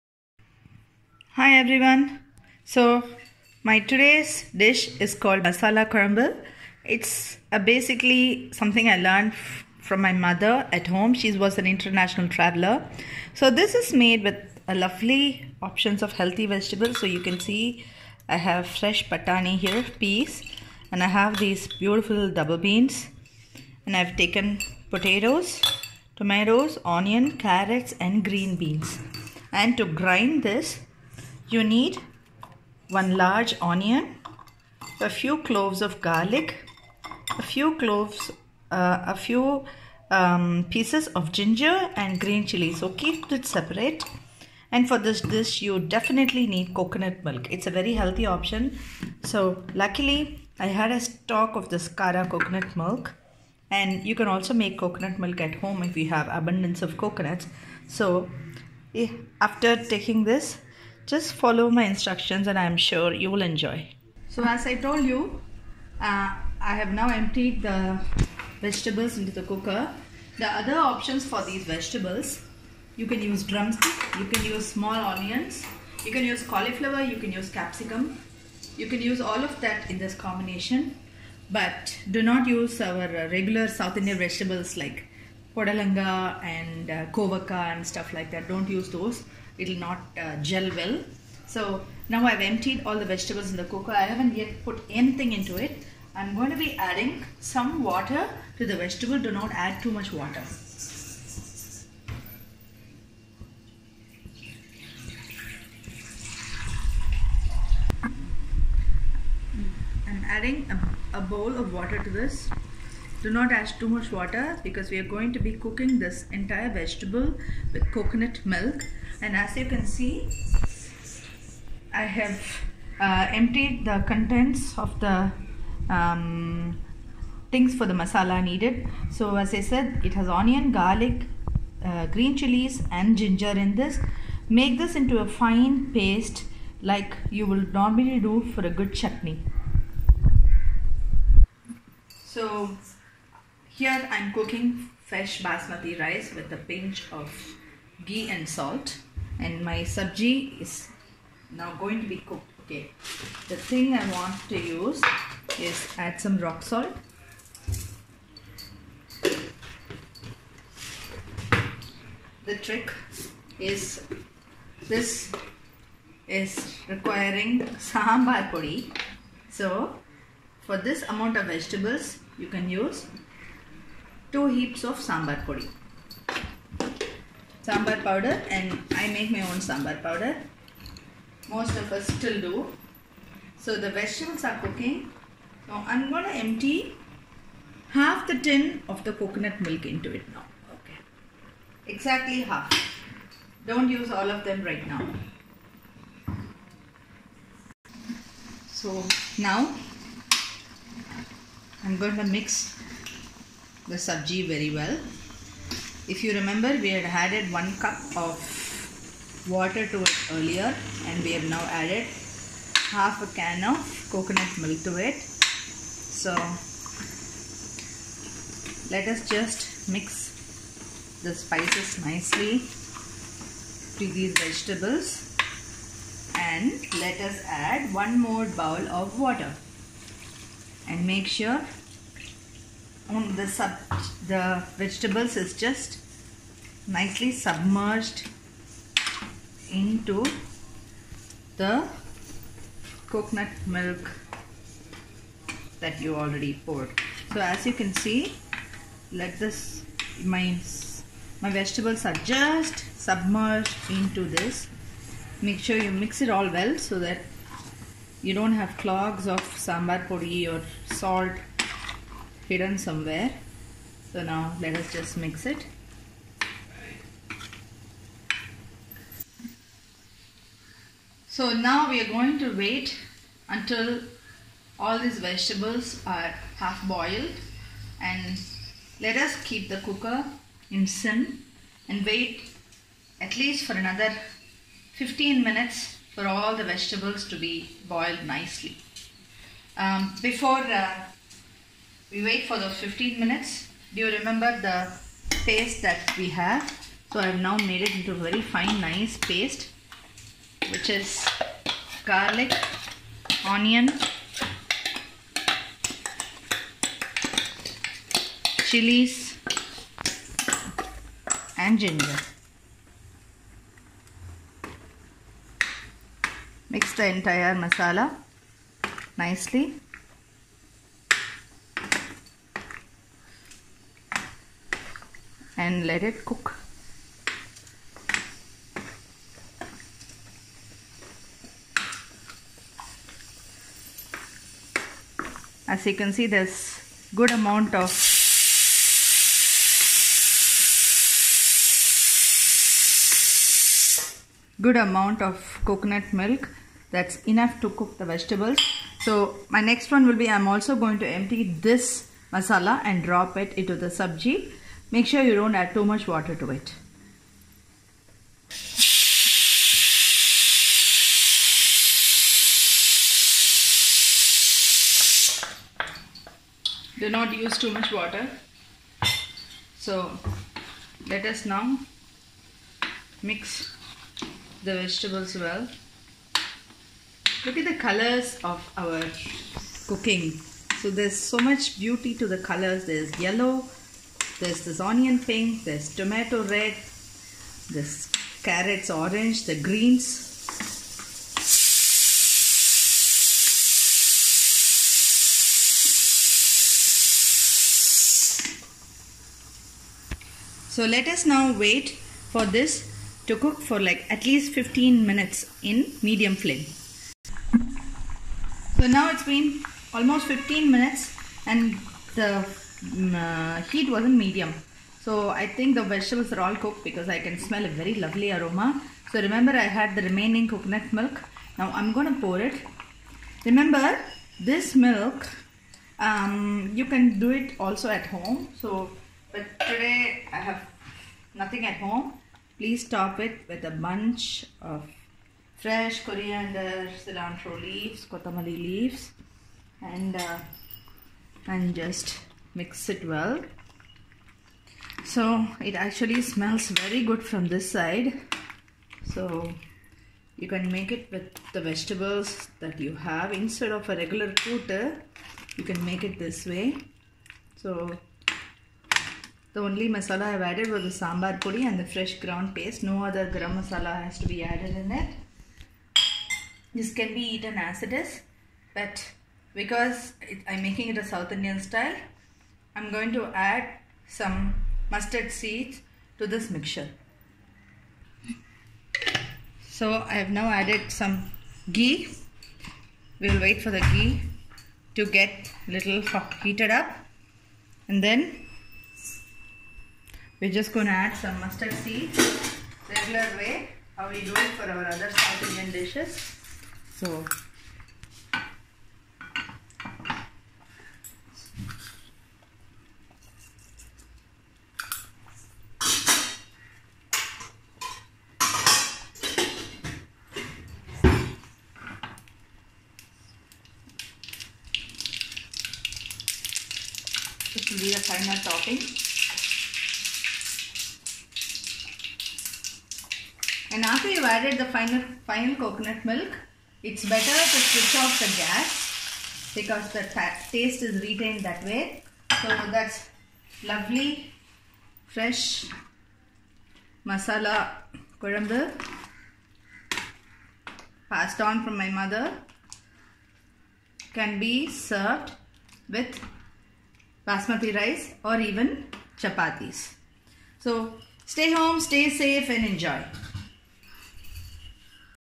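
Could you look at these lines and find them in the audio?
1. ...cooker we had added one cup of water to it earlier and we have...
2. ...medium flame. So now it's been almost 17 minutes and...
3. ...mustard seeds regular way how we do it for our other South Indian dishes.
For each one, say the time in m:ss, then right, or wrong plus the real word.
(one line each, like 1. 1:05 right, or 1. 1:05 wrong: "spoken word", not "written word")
1. 3:26 wrong: "remember", not "cooker"
2. 6:46 wrong: "15", not "17"
3. 8:11 right.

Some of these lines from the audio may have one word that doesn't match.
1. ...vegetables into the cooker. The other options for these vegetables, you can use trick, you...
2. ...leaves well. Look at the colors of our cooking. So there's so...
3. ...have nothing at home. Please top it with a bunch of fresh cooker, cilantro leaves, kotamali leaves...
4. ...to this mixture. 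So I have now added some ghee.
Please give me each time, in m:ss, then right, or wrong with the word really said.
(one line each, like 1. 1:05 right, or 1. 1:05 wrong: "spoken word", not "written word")
1. 1:08 wrong: "drumstick", not "trick"
2. 6:14 wrong: "vegetables", not "leaves"
3. 7:10 wrong: "coriander", not "cooker"
4. 7:56 right.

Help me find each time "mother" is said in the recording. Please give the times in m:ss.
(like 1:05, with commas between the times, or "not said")
0:10, 9:01.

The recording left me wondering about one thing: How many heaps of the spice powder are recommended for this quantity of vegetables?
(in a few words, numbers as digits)
2.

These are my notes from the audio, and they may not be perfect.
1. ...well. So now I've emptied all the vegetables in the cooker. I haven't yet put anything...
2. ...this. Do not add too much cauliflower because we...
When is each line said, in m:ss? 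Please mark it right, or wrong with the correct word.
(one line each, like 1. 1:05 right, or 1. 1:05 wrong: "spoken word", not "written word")
1. 1:30 right
2. 1:52 wrong: "water", not "cauliflower".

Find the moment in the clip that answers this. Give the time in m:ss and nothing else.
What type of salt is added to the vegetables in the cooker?
2:36.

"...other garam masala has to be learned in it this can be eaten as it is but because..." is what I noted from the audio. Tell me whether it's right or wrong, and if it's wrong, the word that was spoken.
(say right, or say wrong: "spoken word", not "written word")
wrong: "added", not "learned".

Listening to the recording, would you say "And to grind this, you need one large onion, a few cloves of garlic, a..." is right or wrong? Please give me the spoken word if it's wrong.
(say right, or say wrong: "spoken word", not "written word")
right.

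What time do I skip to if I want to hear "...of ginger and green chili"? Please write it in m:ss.
0:41.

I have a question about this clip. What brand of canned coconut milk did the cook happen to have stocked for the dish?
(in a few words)
Kara.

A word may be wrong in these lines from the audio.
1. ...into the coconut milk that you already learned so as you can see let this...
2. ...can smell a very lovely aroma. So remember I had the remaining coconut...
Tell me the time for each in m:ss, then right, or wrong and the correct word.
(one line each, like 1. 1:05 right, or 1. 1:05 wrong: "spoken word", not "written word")
1. 3:59 wrong: "poured", not "learned"
2. 6:57 right.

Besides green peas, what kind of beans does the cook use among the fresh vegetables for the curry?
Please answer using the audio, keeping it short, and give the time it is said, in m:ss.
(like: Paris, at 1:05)
double beans, at 0:22.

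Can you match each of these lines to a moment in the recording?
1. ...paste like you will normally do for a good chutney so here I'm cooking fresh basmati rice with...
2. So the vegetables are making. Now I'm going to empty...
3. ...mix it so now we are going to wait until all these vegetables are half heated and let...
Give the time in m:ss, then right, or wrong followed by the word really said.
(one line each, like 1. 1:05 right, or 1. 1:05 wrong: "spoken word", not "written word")
1. 2:15 right
2. 3:03 wrong: "cooking", not "making"
3. 4:25 wrong: "boiled", not "heated".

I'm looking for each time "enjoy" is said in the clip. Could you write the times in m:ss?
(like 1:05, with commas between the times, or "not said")
1:03, 9:12.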